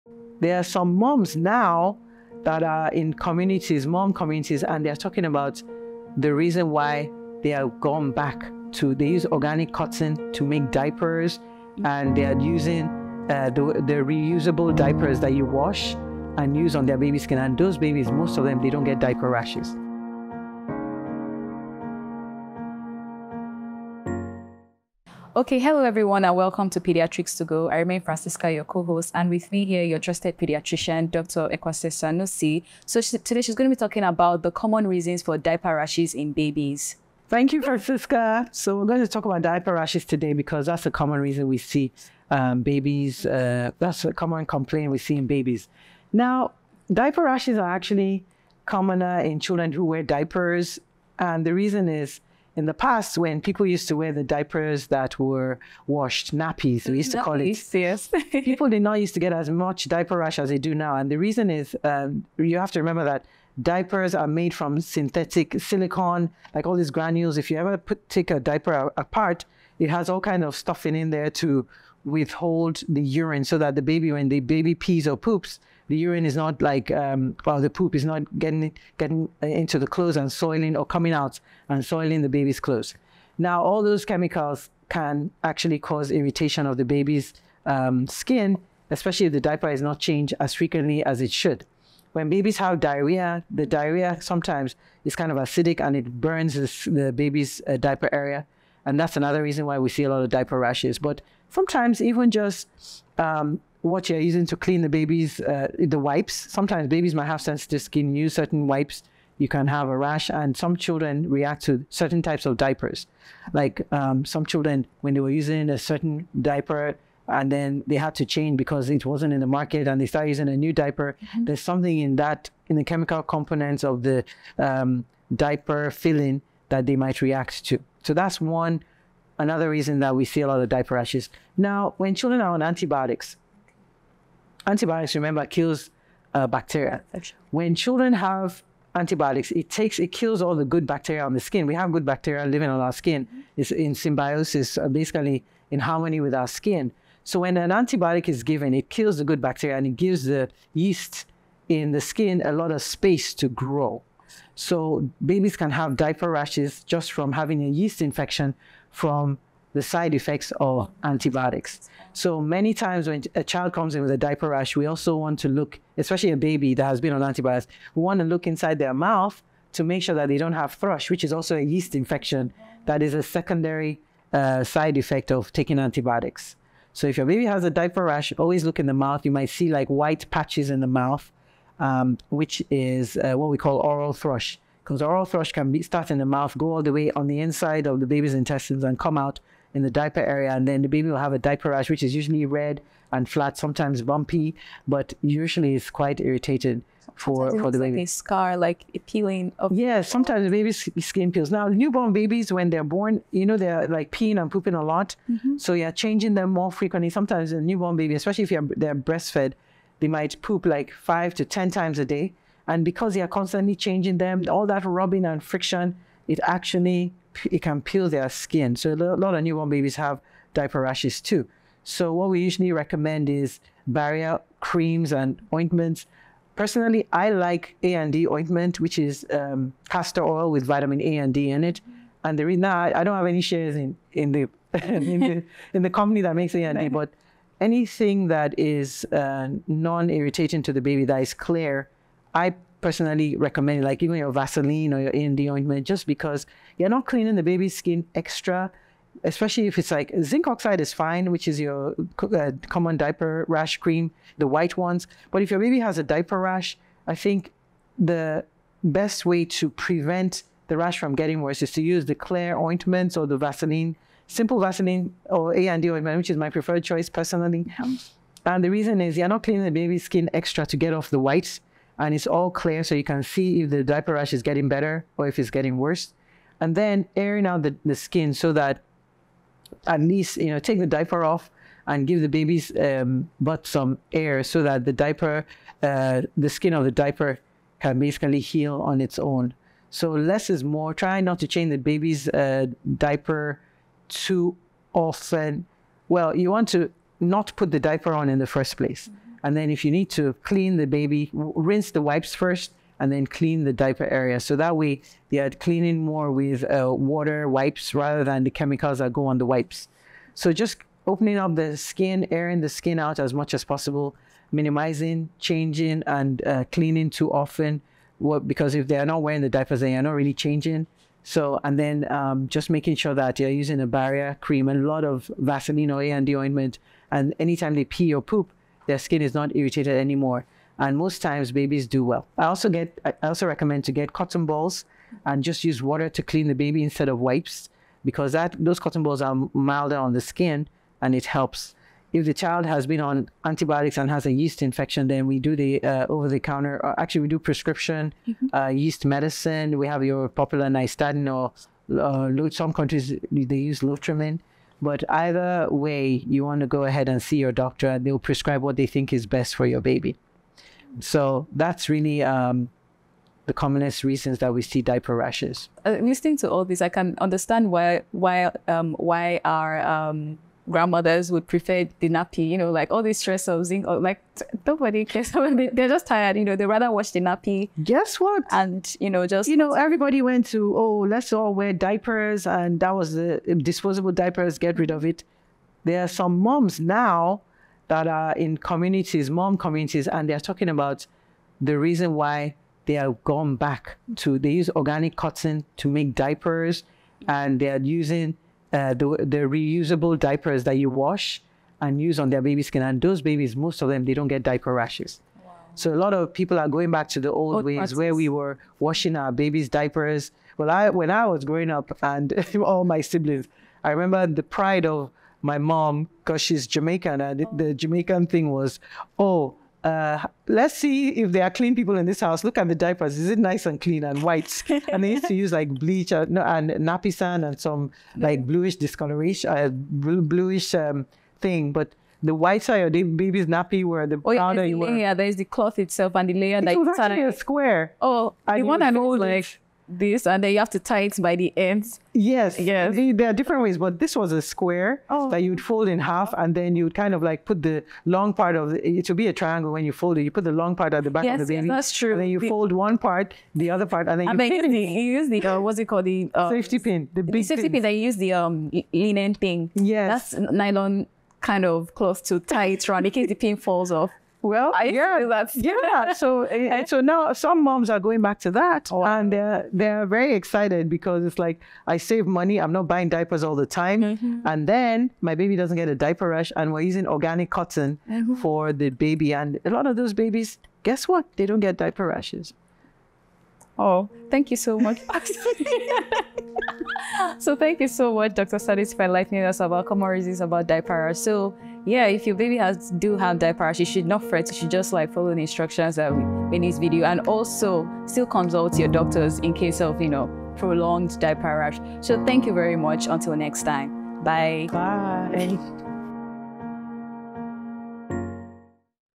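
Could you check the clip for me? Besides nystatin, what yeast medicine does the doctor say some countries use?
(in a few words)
Lotrimin.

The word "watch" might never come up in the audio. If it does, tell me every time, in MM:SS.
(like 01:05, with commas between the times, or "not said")
06:16.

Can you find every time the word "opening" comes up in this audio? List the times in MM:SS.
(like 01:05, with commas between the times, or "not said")
05:11.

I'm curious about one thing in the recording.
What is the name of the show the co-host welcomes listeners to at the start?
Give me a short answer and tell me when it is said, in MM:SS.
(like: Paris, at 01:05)
Pediatrics to Go, at 00:26.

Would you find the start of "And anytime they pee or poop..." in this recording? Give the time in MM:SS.
05:27.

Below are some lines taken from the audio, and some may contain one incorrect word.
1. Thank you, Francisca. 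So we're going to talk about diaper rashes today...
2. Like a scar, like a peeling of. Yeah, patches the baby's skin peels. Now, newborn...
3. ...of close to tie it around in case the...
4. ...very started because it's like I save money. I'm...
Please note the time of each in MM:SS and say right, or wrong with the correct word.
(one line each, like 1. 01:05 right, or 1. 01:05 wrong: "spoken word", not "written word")
1. 00:37 right
2. 03:17 wrong: "sometimes", not "patches"
3. 07:41 right
4. 07:50 wrong: "excited", not "started".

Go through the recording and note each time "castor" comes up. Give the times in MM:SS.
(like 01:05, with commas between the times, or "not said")
03:49.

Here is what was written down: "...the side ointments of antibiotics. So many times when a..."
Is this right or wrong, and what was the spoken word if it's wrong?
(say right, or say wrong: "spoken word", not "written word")
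wrong: "effects", not "ointments".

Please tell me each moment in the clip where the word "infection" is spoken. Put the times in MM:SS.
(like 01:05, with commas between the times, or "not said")
02:38, 02:51, 05:44.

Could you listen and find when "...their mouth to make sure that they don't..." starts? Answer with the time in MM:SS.
02:48.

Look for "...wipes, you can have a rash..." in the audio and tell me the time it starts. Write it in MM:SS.
01:48.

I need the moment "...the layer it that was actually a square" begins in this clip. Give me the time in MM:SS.
07:16.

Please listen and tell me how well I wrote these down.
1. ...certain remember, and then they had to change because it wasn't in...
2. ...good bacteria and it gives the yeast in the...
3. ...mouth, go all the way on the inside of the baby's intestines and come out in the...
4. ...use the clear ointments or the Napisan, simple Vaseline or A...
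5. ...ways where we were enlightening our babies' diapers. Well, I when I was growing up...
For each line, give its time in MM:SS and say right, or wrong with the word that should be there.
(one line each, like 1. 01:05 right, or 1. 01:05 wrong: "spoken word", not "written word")
1. 01:55 wrong: "diaper", not "remember"
2. 02:29 right
3. 03:06 right
4. 04:21 wrong: "Vaseline", not "Napisan"
5. 06:47 wrong: "washing", not "enlightening".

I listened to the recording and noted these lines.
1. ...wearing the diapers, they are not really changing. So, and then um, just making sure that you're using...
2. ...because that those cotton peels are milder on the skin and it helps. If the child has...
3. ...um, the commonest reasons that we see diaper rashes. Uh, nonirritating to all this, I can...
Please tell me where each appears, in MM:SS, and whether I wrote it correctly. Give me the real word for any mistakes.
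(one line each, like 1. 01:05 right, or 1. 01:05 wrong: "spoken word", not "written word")
1. 05:19 right
2. 05:38 wrong: "balls", not "peels"
3. 06:02 wrong: "listening", not "nonirritating".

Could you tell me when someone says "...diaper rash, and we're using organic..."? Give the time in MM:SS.
07:55.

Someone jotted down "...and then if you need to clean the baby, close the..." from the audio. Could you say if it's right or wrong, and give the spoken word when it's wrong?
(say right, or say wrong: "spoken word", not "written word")
wrong: "rinse", not "close".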